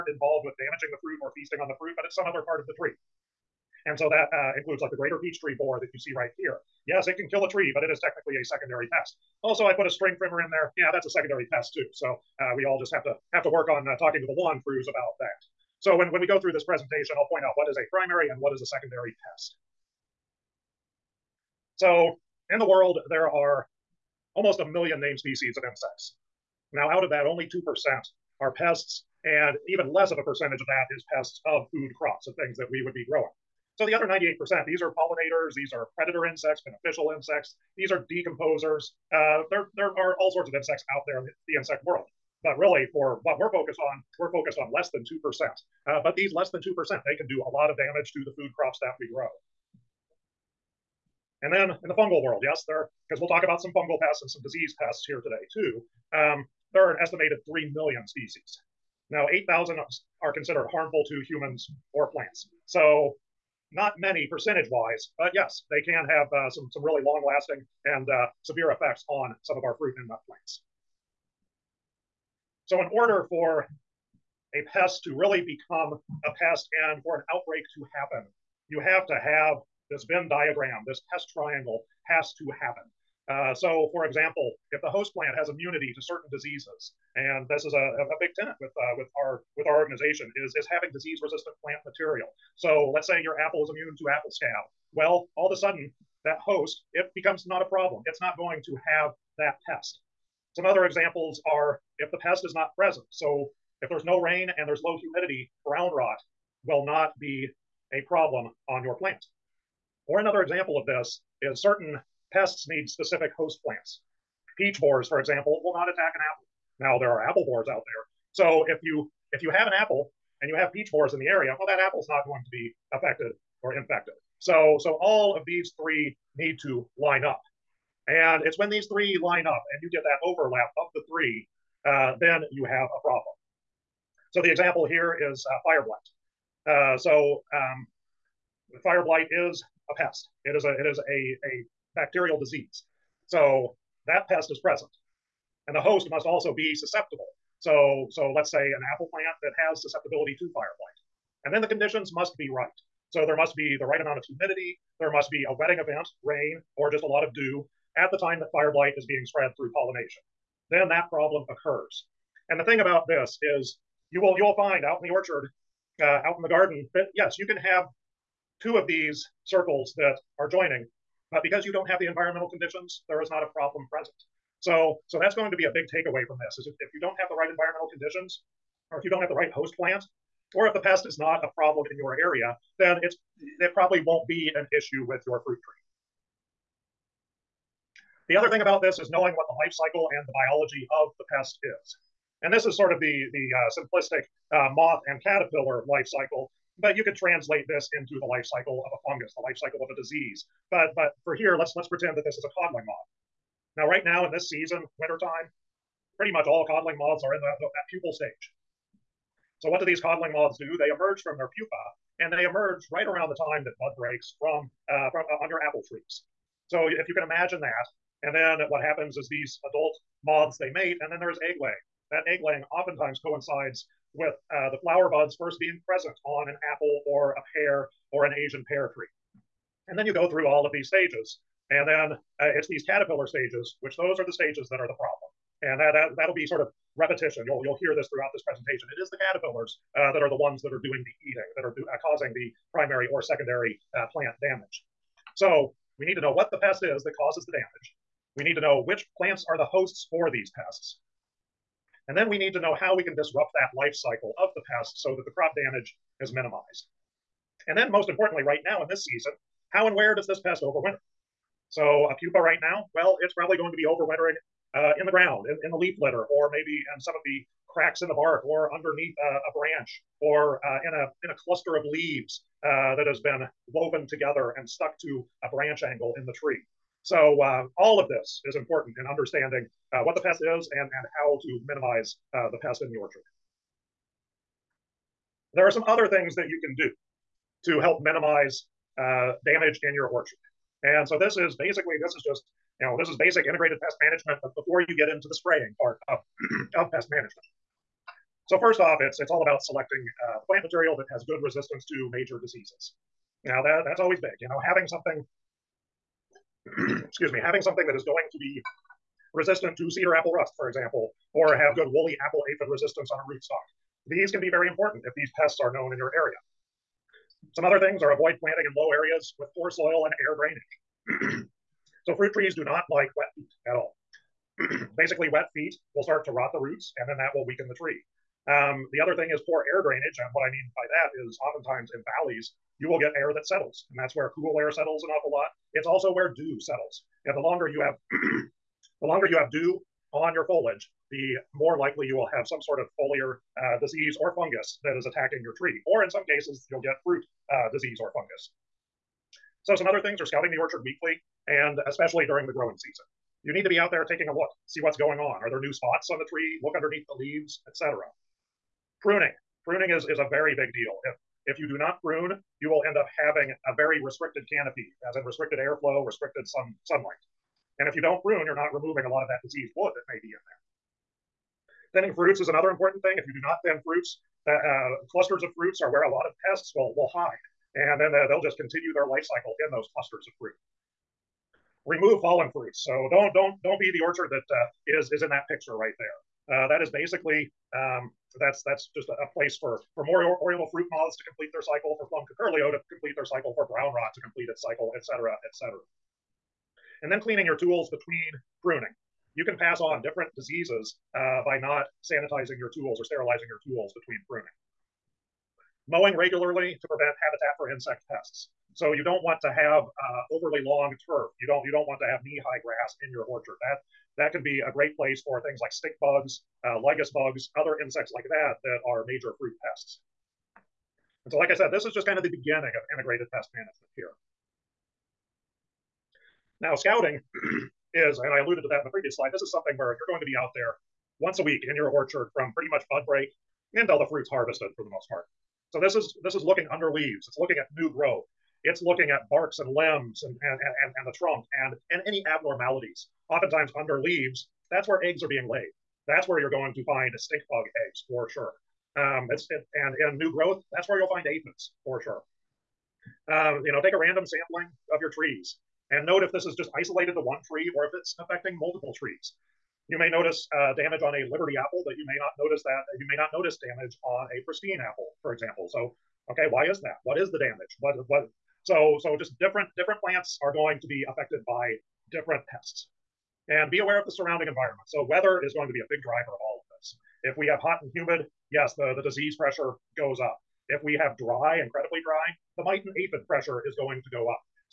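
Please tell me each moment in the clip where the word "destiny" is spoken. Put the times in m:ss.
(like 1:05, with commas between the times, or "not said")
not said.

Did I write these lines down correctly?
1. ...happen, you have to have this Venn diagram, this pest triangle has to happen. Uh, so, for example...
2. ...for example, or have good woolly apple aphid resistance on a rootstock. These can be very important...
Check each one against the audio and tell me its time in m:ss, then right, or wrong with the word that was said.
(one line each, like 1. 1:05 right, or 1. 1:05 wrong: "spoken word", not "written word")
1. 1:17 right
2. 5:10 right.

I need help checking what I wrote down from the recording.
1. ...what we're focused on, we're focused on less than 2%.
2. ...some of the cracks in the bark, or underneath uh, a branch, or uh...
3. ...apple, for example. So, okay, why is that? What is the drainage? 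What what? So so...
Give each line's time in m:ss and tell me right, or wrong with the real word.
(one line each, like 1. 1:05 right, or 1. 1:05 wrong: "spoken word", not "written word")
1. 0:43 right
2. 4:27 right
3. 7:44 wrong: "damage", not "drainage".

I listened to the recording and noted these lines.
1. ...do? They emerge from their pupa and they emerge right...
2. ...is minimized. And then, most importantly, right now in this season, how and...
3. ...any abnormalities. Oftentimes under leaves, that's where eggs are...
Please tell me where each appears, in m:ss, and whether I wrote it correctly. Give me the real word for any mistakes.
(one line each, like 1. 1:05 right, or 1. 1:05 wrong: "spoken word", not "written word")
1. 3:30 right
2. 4:16 right
3. 7:22 right.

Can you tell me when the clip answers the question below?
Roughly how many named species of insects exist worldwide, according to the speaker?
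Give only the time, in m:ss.
0:24.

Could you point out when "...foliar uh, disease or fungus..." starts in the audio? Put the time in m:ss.
5:42.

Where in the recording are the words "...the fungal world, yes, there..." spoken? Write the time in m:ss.
0:51.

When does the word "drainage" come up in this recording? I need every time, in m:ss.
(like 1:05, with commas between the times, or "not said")
5:20, 5:29.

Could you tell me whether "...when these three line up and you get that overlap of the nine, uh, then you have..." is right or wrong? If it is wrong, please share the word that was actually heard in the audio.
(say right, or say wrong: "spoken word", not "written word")
wrong: "three", not "nine".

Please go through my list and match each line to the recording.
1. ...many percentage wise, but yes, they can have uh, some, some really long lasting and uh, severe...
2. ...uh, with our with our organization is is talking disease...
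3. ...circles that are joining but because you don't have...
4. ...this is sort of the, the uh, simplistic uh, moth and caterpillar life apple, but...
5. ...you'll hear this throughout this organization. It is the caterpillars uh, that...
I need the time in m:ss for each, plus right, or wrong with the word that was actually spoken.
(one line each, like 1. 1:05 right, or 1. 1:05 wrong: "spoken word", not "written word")
1. 1:03 right
2. 1:28 wrong: "having", not "talking"
3. 2:49 right
4. 3:12 wrong: "cycle", not "apple"
5. 3:57 wrong: "presentation", not "organization".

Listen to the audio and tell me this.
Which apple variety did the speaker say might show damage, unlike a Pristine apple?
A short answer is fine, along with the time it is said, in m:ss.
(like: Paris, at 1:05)
Liberty, at 7:41.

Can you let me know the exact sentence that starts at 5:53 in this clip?
You need to be out there taking a look, see what's going on.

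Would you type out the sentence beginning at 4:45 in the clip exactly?
There are some other things that you can do to help minimize uh, damage in your orchard.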